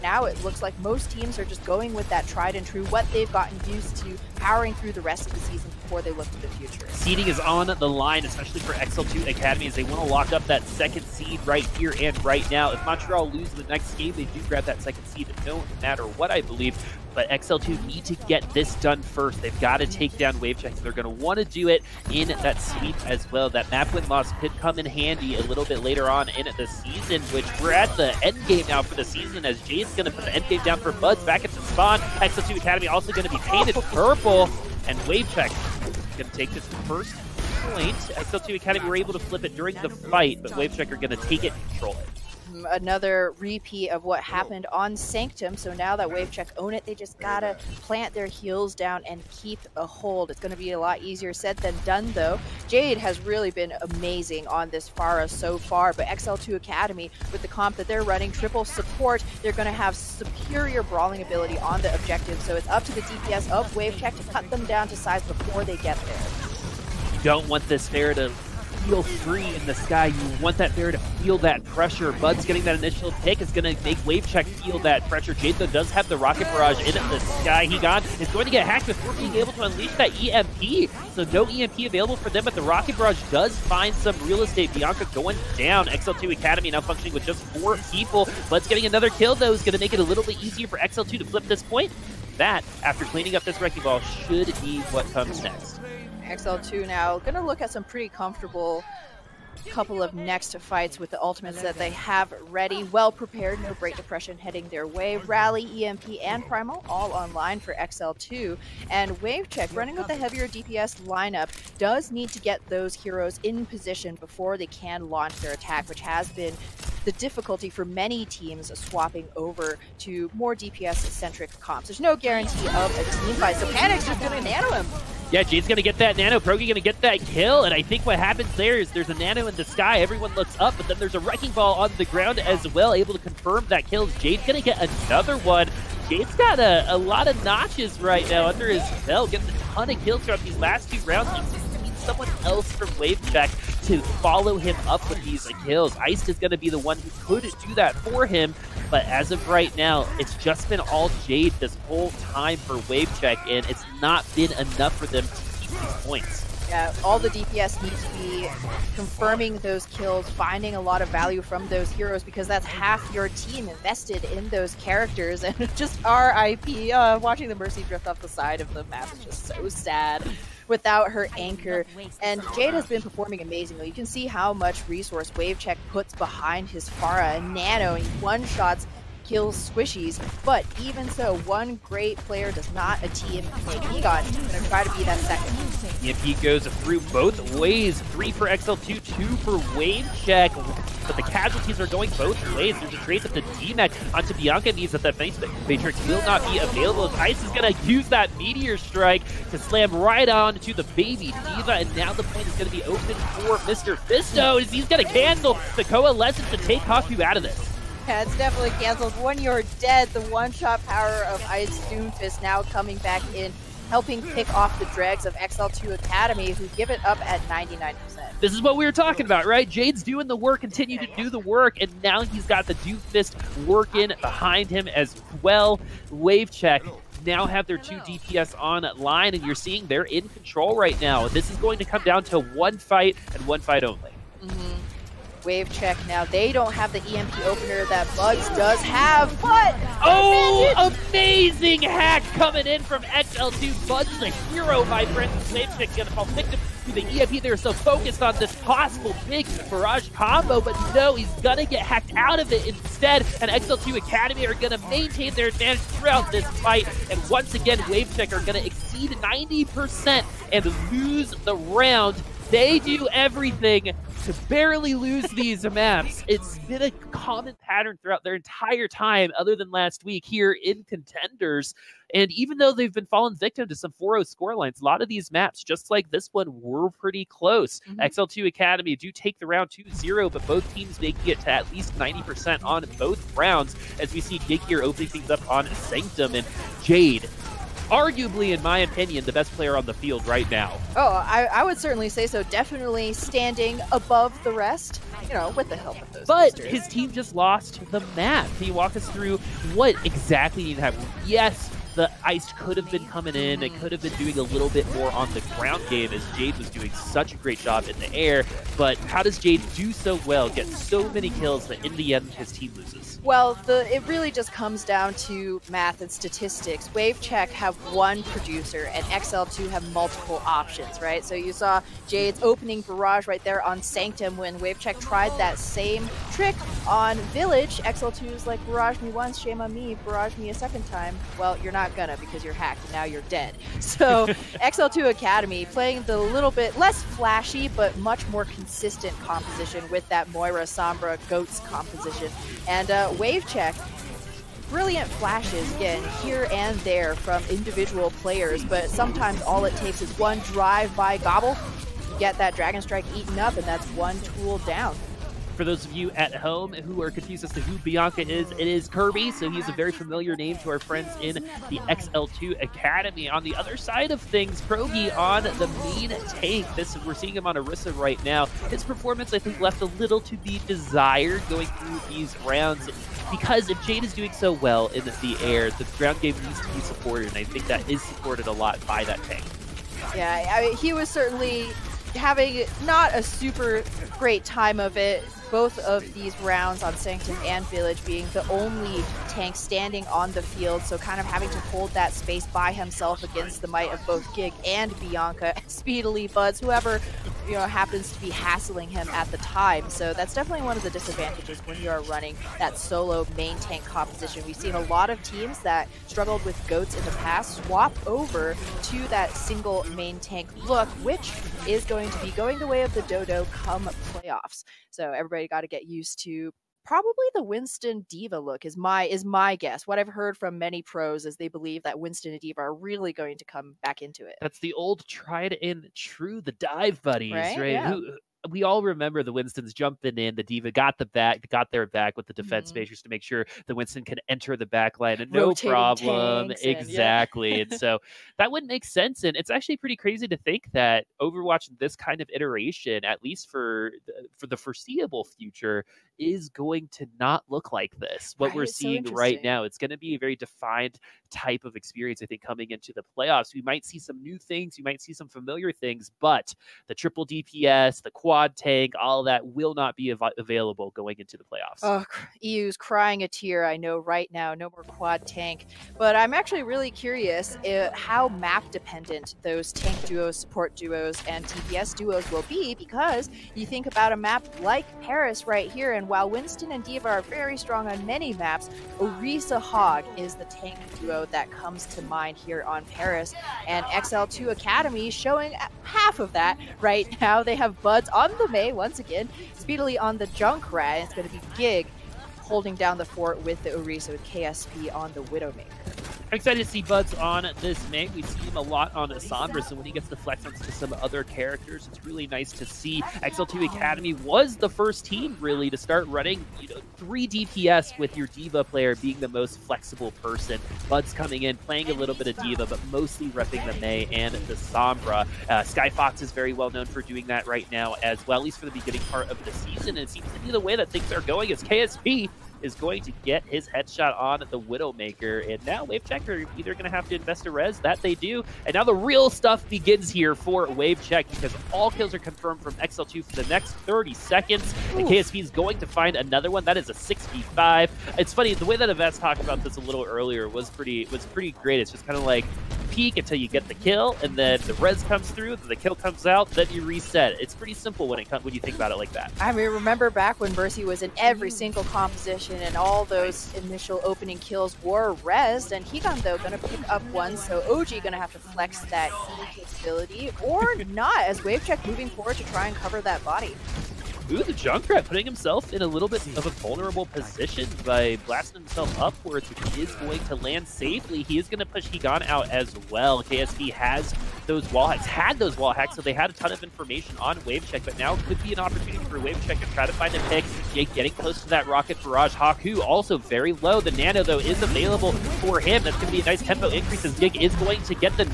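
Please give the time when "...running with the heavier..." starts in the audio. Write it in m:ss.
1:49.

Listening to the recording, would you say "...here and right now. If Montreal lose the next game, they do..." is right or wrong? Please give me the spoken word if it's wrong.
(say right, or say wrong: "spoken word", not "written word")
right.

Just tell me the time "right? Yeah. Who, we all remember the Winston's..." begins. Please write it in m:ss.
7:07.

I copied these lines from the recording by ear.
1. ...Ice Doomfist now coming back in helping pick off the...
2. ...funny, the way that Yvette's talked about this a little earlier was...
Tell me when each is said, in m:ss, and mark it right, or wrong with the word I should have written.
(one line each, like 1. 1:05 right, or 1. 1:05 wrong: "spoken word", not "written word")
1. 3:31 right
2. 8:58 right.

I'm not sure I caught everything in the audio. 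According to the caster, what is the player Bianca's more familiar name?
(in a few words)
Kirby.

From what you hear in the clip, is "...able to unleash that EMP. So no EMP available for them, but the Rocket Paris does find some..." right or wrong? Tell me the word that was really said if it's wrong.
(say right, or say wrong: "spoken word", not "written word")
wrong: "Barrage", not "Paris".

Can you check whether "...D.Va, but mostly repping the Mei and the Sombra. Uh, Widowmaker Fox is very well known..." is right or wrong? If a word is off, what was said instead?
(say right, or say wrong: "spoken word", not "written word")
wrong: "Sky", not "Widowmaker".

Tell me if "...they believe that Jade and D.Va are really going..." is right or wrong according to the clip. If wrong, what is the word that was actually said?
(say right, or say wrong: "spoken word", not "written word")
wrong: "Winston", not "Jade".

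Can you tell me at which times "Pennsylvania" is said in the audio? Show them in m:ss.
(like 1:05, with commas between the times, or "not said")
not said.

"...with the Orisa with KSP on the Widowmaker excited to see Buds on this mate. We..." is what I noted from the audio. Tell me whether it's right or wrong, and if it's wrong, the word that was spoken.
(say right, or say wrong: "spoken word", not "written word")
right.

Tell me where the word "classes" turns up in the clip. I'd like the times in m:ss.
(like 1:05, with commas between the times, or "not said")
not said.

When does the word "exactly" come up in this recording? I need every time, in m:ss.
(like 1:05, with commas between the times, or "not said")
5:00, 7:16.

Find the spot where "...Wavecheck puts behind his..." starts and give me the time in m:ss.
2:55.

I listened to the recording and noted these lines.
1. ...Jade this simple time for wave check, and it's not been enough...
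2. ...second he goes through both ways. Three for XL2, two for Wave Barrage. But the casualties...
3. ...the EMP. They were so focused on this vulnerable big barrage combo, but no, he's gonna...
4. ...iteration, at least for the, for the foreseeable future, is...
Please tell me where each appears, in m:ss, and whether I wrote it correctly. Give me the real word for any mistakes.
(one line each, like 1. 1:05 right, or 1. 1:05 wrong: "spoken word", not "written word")
1. 2:31 wrong: "whole", not "simple"
2. 3:05 wrong: "Check", not "Barrage"
3. 4:06 wrong: "possible", not "vulnerable"
4. 7:22 right.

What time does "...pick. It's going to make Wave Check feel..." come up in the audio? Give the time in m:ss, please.
1:13.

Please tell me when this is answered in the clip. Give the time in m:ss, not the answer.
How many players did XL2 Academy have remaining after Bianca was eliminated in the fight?
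1:27.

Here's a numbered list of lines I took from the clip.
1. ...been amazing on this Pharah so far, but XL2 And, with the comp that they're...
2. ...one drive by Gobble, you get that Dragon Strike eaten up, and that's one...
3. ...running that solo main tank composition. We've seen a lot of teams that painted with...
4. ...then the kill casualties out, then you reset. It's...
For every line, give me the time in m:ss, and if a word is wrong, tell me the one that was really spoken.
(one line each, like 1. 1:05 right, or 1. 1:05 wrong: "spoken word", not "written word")
1. 0:53 wrong: "Academy", not "And"
2. 5:50 right
3. 6:42 wrong: "struggled", not "painted"
4. 9:05 wrong: "comes", not "casualties".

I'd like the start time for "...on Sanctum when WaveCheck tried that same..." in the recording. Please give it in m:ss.
5:23.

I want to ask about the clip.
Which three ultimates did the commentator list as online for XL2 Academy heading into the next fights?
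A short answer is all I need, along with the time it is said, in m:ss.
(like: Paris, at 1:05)
Rally, EMP, and Primal, at 1:45.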